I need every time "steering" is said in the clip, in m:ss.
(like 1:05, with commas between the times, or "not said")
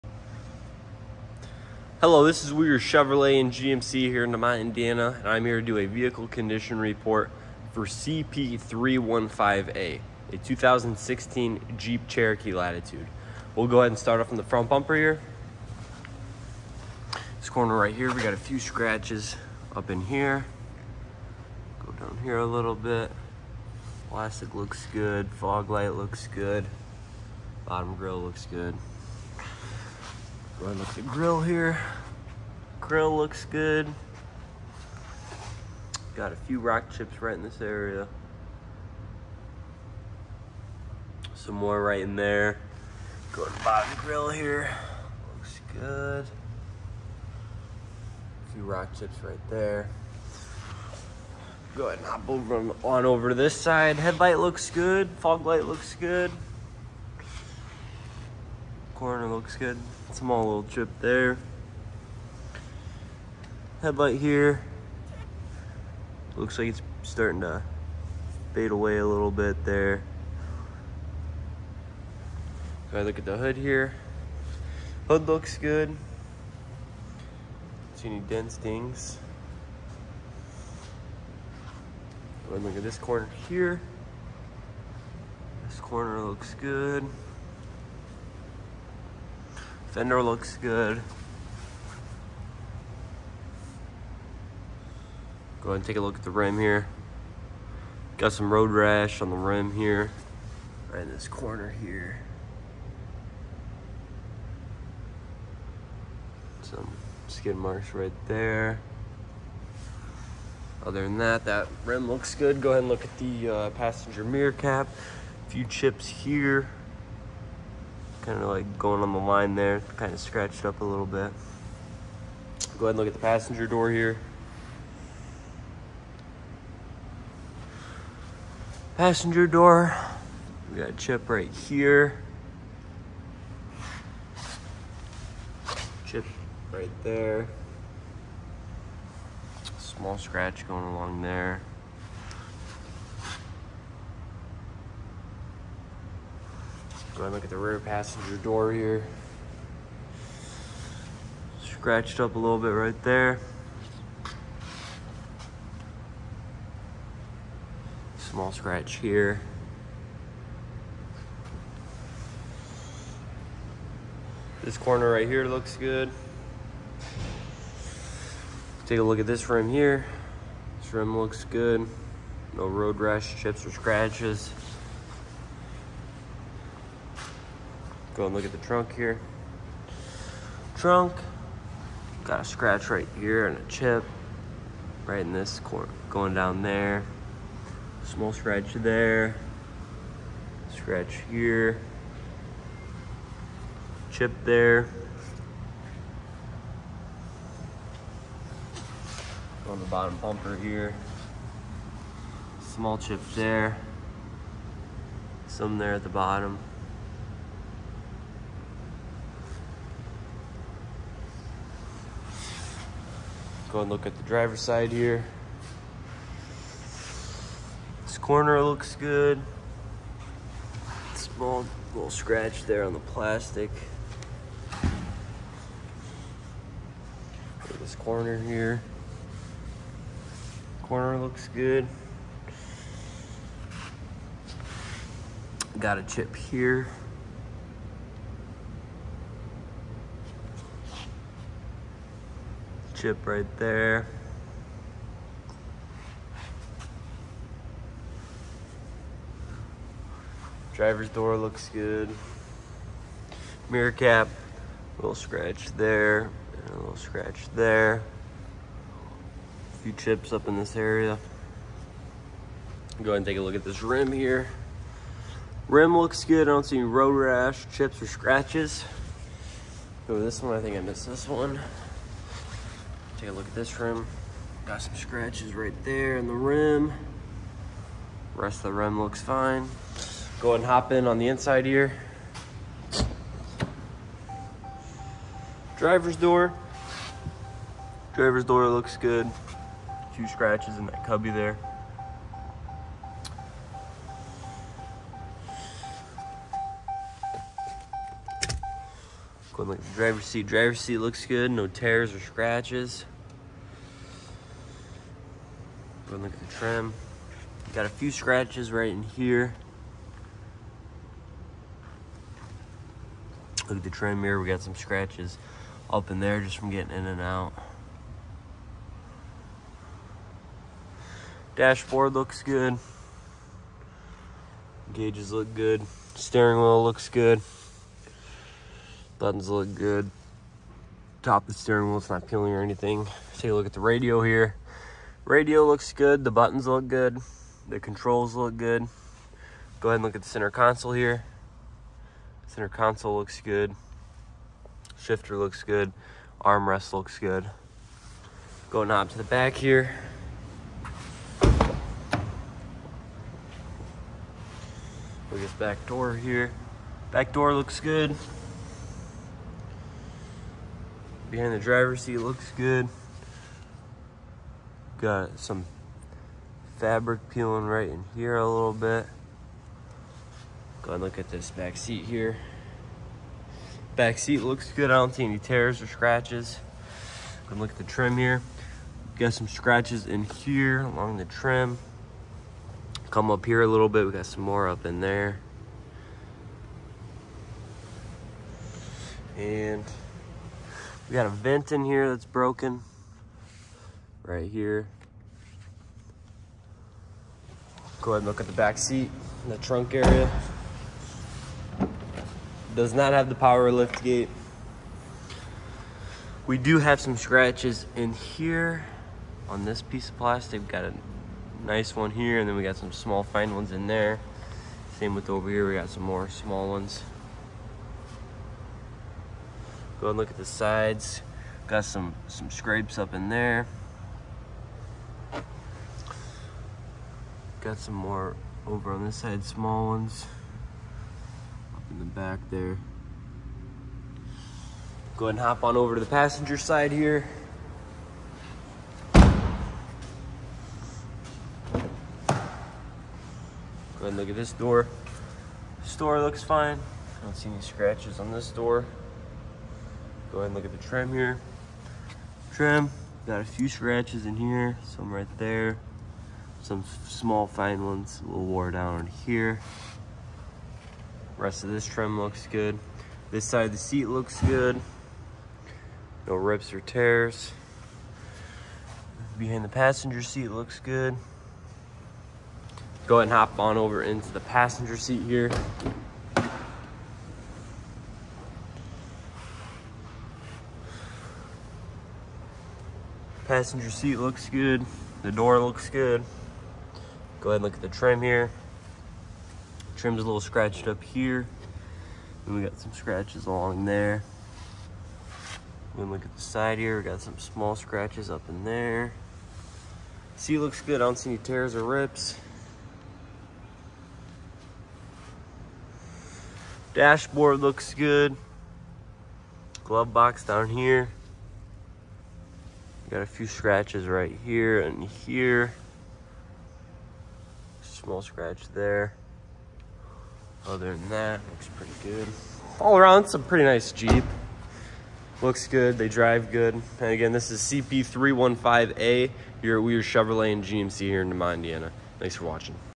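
5:26, 5:31.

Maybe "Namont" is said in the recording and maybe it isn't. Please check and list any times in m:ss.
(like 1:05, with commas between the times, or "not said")
0:04.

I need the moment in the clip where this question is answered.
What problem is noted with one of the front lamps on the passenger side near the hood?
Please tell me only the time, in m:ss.
1:07.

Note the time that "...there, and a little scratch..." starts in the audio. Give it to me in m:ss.
4:15.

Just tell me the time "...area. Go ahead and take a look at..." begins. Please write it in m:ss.
4:20.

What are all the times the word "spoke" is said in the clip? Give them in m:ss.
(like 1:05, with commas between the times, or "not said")
not said.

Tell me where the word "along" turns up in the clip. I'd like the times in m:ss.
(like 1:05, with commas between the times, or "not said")
2:20, 6:20, 8:13.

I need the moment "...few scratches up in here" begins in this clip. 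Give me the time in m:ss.
0:18.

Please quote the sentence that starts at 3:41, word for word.
Small little scratch there on the plastic.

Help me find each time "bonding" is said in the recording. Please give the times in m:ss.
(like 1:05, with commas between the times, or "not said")
not said.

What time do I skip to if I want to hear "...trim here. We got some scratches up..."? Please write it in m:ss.
5:13.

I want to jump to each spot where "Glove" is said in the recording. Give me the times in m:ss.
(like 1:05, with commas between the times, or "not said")
8:29.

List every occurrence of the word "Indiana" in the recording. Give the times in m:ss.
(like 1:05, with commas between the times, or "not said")
0:04, 8:51.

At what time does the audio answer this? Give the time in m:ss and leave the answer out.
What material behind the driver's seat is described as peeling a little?
6:06.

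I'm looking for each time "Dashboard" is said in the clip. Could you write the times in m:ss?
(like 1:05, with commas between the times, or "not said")
5:21, 8:26.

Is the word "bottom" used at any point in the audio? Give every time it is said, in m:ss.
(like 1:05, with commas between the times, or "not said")
0:27, 0:43, 3:19, 3:26.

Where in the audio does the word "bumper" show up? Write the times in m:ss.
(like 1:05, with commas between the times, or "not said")
0:14, 3:20.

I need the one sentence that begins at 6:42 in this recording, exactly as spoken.
Does not have the power lift gate.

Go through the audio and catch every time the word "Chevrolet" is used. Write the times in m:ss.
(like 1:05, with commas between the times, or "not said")
0:02, 8:50.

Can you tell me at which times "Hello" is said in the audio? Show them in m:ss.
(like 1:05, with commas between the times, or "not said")
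0:02.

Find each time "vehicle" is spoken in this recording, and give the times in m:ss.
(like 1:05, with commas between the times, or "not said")
0:05.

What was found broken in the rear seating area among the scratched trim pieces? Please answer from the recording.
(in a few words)
A vent.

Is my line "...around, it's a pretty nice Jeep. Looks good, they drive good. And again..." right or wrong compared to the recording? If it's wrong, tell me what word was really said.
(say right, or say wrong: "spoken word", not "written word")
right.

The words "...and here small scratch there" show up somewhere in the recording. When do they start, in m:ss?
8:34.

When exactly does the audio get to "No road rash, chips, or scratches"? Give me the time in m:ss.
2:52.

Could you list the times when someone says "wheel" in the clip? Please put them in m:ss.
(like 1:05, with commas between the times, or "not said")
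5:26, 5:31.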